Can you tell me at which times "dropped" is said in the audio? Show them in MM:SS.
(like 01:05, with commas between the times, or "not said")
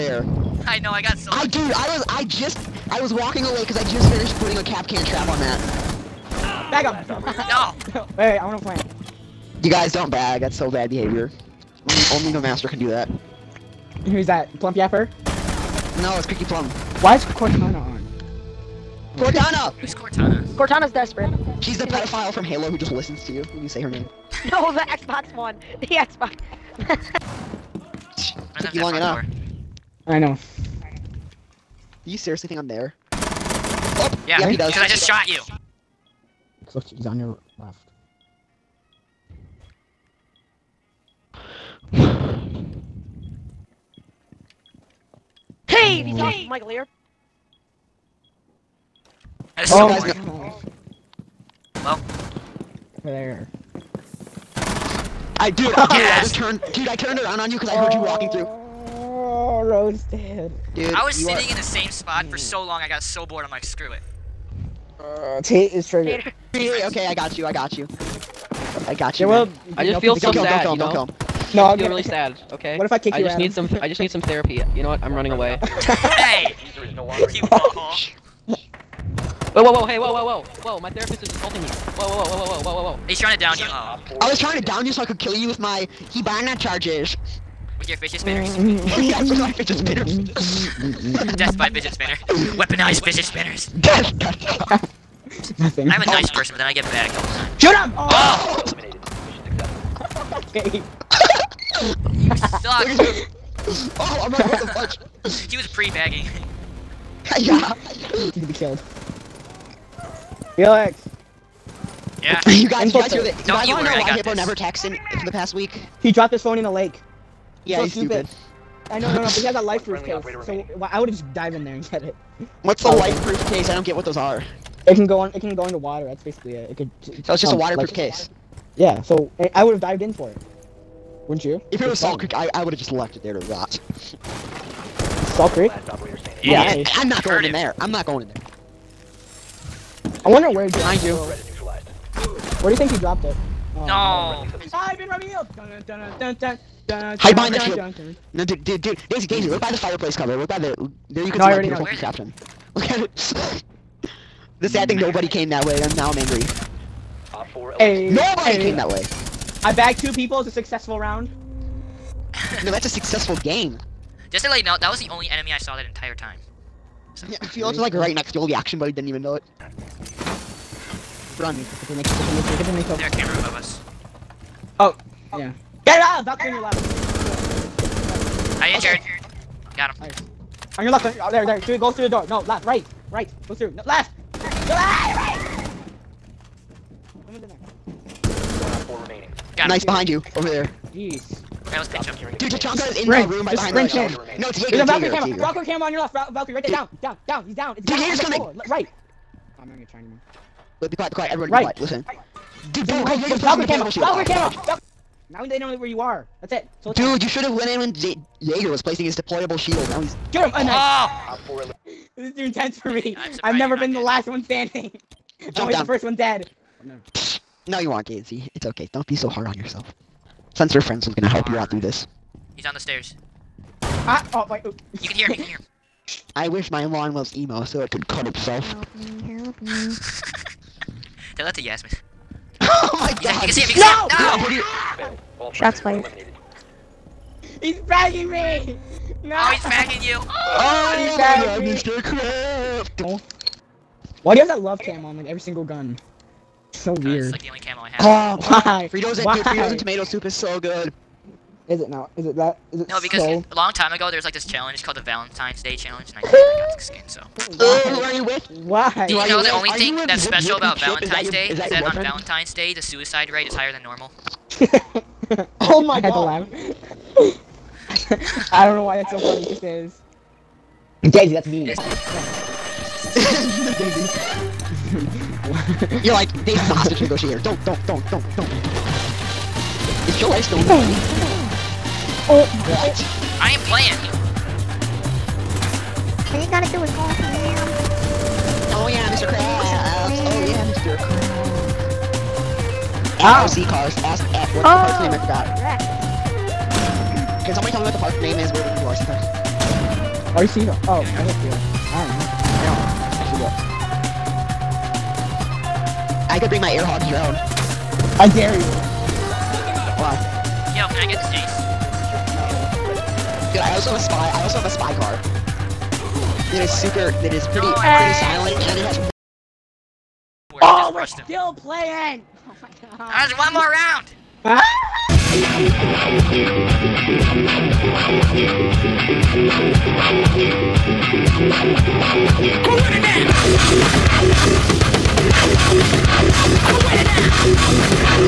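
01:56, 02:22.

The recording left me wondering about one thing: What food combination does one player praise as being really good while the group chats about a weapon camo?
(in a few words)
Fritos and tomato soup.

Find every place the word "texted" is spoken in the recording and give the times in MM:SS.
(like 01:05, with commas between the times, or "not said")
01:54.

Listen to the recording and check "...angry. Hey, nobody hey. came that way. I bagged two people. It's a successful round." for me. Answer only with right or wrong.
right.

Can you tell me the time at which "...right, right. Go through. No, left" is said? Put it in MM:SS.
03:02.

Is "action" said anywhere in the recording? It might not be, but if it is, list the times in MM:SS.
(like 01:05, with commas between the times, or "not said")
02:48.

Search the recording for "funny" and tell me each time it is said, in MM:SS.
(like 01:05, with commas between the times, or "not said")
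04:29.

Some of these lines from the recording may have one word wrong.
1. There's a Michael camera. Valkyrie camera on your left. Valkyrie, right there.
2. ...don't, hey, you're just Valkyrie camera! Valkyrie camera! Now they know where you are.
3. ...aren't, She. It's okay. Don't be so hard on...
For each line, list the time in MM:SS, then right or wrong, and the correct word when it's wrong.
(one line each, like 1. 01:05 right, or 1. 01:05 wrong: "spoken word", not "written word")
1. 03:14 wrong: "Valkyrie", not "Michael"
2. 03:22 right
3. 03:37 wrong: "Daisy", not "She".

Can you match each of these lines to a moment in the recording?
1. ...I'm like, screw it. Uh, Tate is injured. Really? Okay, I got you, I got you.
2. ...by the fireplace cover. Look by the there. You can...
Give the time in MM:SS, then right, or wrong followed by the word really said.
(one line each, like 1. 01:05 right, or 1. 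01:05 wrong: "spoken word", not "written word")
1. 01:03 wrong: "triggered", not "injured"
2. 02:29 right.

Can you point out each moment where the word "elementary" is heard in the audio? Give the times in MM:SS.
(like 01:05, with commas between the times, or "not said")
not said.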